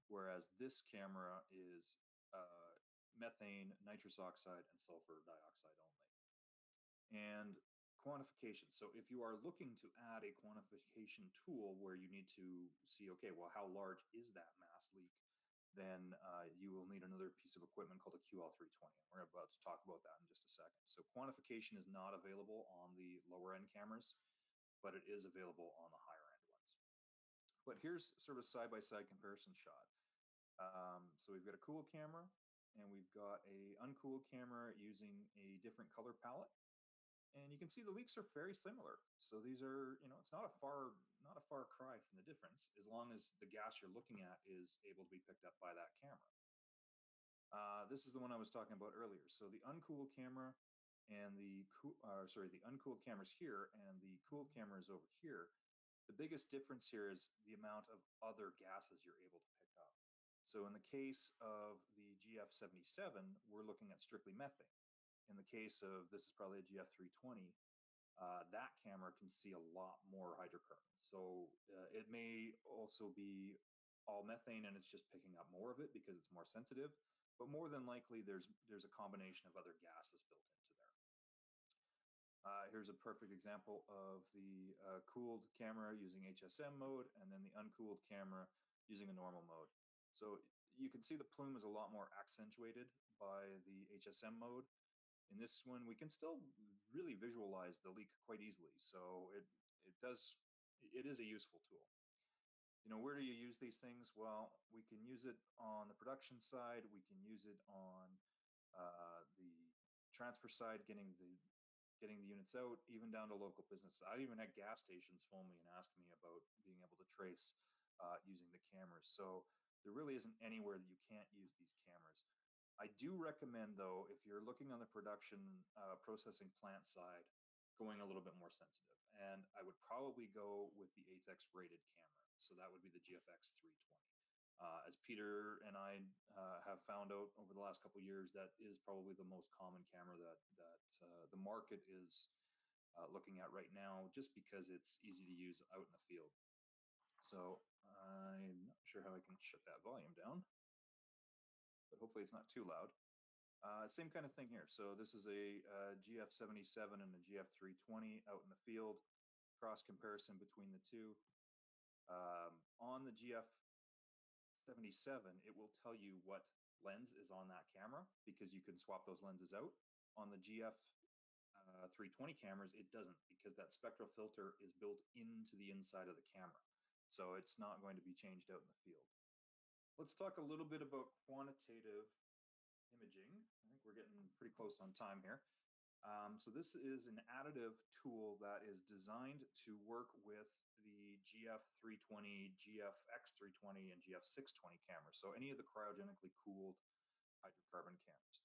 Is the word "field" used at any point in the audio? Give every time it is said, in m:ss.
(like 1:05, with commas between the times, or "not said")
2:25, 2:38, 2:58.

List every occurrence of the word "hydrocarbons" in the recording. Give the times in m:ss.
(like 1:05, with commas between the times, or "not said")
1:10, 3:17.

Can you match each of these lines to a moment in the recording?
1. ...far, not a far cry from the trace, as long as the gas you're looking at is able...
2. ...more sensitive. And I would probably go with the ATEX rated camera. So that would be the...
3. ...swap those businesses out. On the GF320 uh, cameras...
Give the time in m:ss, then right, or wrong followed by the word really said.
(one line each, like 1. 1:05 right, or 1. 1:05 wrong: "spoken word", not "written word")
1. 0:40 wrong: "difference", not "trace"
2. 2:08 right
3. 2:48 wrong: "lenses", not "businesses".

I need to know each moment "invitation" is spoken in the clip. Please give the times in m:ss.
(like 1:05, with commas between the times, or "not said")
not said.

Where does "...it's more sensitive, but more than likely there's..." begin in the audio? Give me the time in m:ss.
1:16.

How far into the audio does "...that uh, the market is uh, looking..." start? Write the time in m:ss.
2:20.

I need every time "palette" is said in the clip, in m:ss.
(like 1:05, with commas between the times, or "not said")
0:36.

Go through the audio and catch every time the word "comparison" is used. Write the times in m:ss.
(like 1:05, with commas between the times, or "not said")
0:29, 2:39.